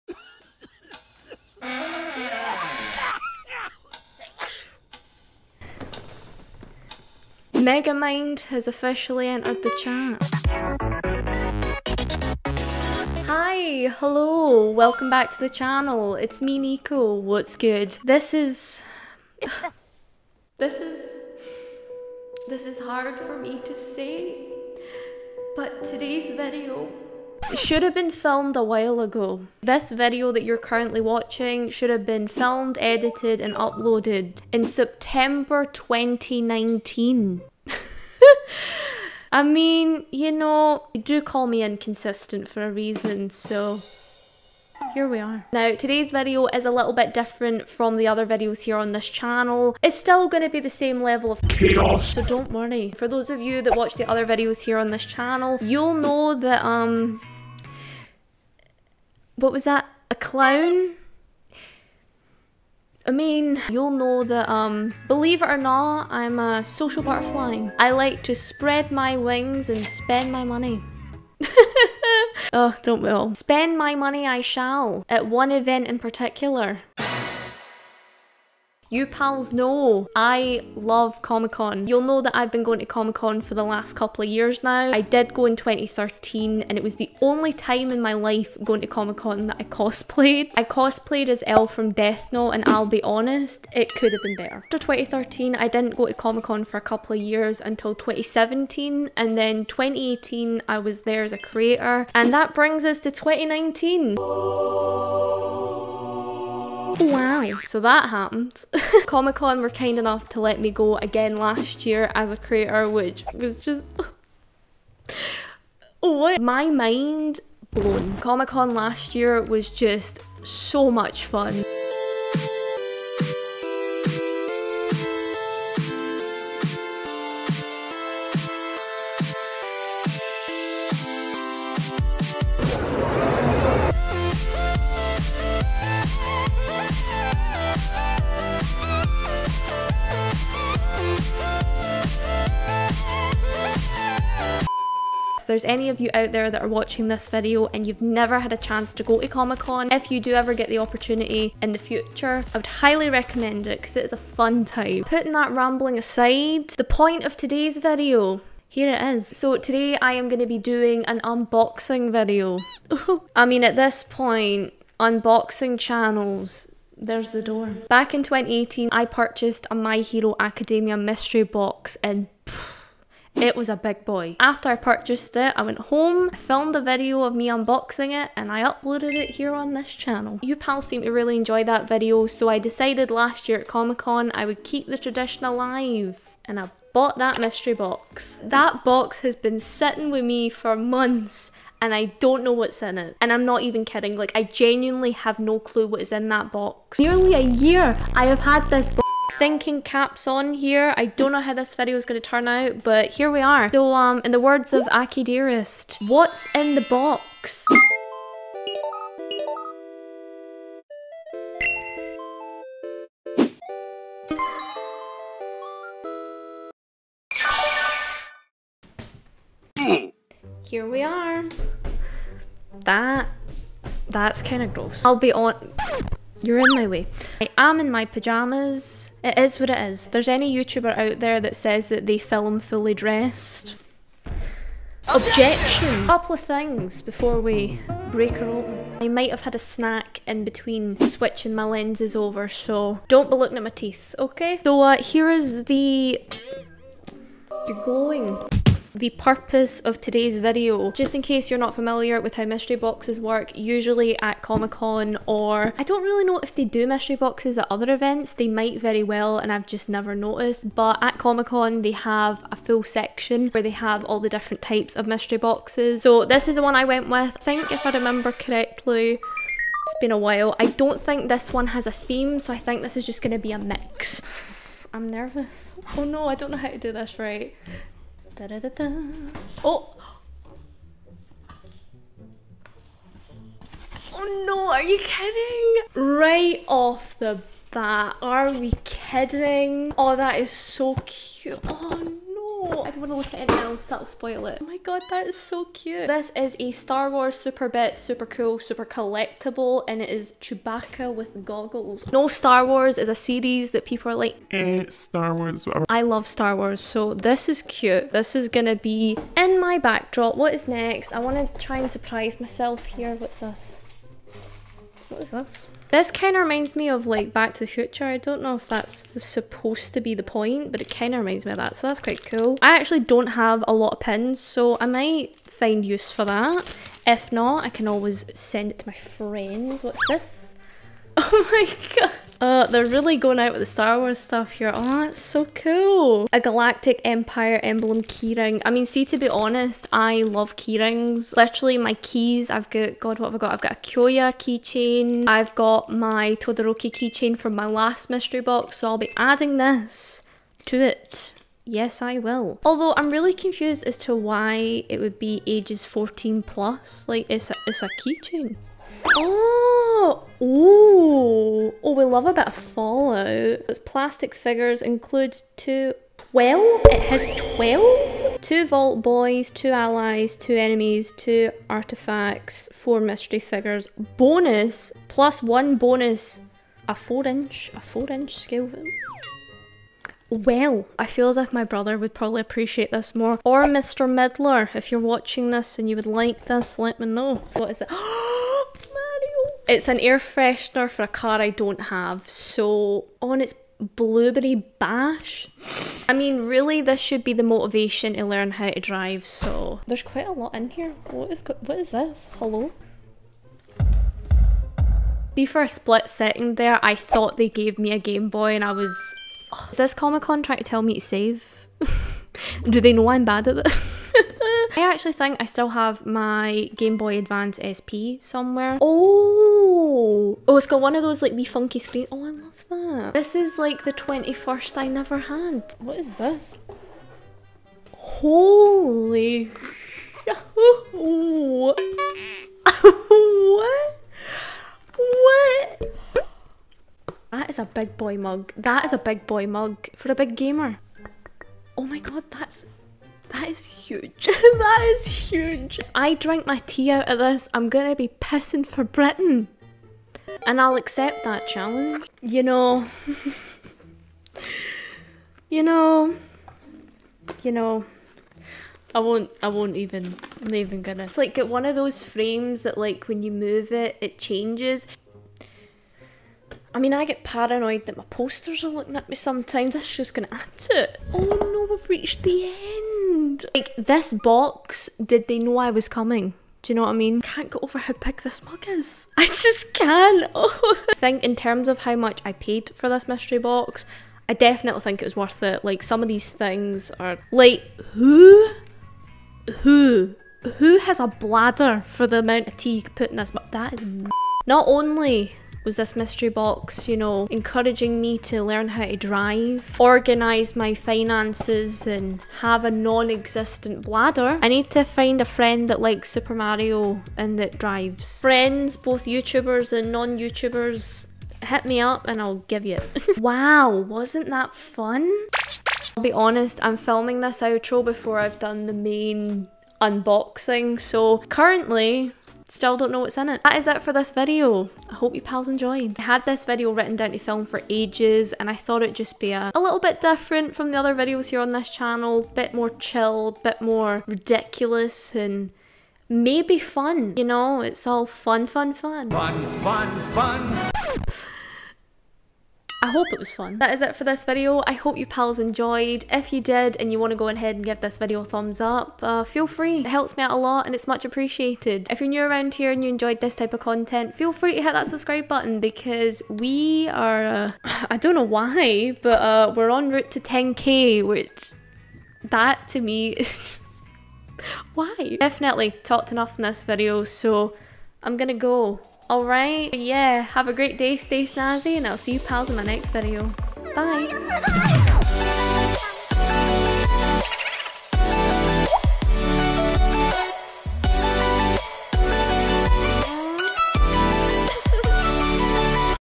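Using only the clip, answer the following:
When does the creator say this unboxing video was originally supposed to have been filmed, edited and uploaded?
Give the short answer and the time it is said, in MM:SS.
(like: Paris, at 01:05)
September 2019, at 00:34.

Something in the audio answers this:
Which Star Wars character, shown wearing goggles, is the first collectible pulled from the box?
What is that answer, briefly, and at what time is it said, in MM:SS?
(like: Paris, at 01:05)
Chewbacca, at 05:00.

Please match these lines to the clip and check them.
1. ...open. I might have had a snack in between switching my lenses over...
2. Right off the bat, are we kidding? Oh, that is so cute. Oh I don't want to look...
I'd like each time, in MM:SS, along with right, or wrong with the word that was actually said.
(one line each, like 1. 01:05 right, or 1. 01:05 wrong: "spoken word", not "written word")
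1. 03:58 right
2. 04:46 right.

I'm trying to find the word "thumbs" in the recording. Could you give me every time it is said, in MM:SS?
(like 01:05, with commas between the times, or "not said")
09:08.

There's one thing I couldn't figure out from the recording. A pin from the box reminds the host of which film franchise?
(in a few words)
Back to the Future.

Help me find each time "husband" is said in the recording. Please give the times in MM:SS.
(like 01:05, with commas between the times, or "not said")
not said.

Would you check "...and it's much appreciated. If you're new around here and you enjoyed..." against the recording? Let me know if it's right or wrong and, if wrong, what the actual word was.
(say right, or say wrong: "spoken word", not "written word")
right.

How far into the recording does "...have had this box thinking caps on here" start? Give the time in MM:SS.
03:18.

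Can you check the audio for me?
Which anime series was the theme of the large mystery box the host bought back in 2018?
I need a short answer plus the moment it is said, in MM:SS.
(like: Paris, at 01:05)
My Hero Academia, at 02:49.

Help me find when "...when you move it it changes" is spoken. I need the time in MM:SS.
07:43.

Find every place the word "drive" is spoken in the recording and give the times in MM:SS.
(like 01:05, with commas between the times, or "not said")
06:38, 08:18, 08:27.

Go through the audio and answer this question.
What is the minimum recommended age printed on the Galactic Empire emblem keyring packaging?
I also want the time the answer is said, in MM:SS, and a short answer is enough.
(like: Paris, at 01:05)
14 plus, at 05:55.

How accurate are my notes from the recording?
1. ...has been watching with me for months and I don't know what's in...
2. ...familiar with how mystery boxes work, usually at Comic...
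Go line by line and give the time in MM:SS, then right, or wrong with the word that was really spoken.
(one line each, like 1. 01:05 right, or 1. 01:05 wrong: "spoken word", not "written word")
1. 03:09 wrong: "sitting", not "watching"
2. 04:11 right.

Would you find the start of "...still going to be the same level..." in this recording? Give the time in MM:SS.
00:49.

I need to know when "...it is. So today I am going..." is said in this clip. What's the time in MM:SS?
02:38.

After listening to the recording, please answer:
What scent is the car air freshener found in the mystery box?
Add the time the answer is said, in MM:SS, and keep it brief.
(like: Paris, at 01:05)
Blueberry bash, at 06:33.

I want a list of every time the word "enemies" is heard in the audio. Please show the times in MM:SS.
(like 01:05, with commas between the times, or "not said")
06:10.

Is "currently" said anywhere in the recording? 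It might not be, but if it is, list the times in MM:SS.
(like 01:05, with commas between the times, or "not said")
00:30, 08:41.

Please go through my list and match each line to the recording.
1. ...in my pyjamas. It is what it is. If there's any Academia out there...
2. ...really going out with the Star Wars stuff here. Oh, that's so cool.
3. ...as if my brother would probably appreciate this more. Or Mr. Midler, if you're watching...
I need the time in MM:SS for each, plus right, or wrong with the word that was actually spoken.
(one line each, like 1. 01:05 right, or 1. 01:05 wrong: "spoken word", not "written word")
1. 03:47 wrong: "YouTuber", not "Academia"
2. 05:32 right
3. 06:21 right.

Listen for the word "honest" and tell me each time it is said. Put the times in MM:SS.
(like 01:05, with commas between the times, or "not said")
01:33, 05:39, 08:36.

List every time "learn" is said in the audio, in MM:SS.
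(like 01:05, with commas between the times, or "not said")
06:38, 08:18.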